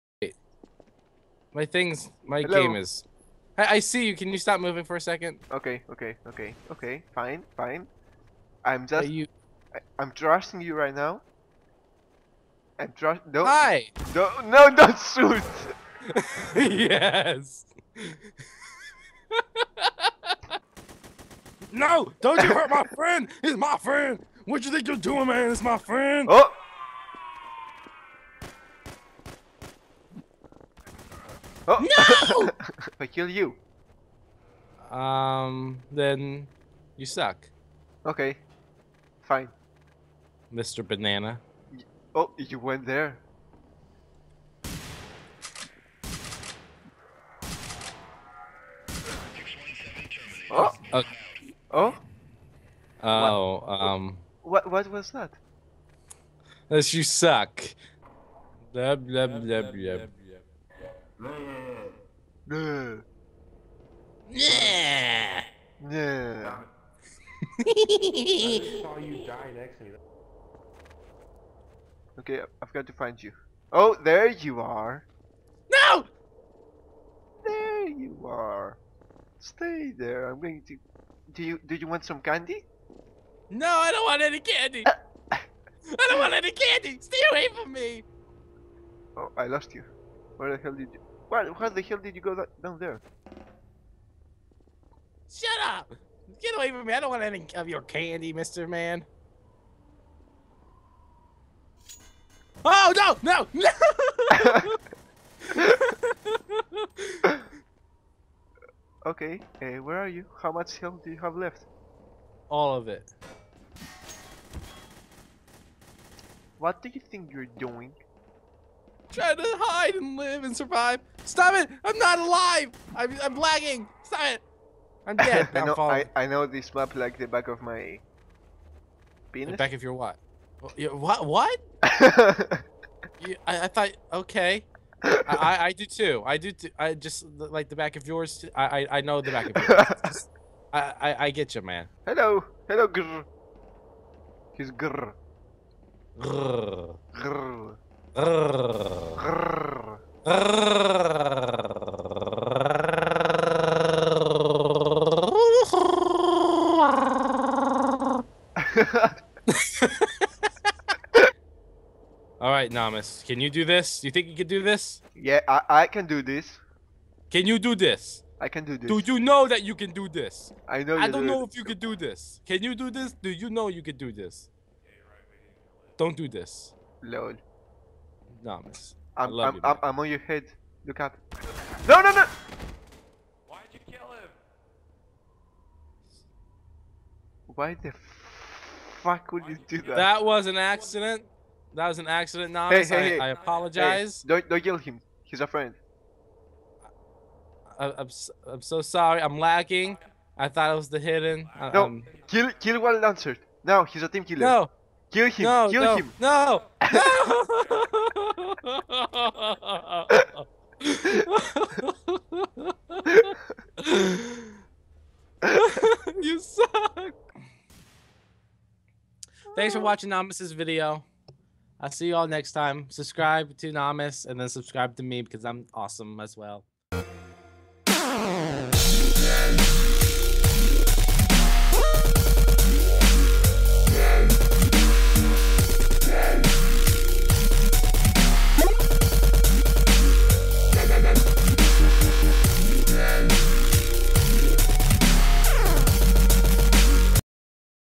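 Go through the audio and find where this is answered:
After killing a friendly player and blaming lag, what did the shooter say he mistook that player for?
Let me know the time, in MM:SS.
03:20.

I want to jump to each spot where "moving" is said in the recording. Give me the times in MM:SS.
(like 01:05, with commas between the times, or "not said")
00:04.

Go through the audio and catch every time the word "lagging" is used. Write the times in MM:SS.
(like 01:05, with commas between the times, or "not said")
02:03, 03:19.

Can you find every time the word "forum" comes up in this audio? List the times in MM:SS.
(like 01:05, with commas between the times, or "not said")
not said.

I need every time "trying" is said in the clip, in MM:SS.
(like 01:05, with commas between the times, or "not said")
01:59.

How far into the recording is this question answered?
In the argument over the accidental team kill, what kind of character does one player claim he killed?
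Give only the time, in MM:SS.
03:23.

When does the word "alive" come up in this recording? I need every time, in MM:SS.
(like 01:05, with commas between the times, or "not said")
02:02.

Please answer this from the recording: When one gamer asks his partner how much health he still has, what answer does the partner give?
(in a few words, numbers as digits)
All of it.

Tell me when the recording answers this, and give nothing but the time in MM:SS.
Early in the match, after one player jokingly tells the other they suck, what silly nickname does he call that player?
00:40.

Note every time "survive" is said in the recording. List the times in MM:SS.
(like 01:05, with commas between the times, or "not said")
02:00.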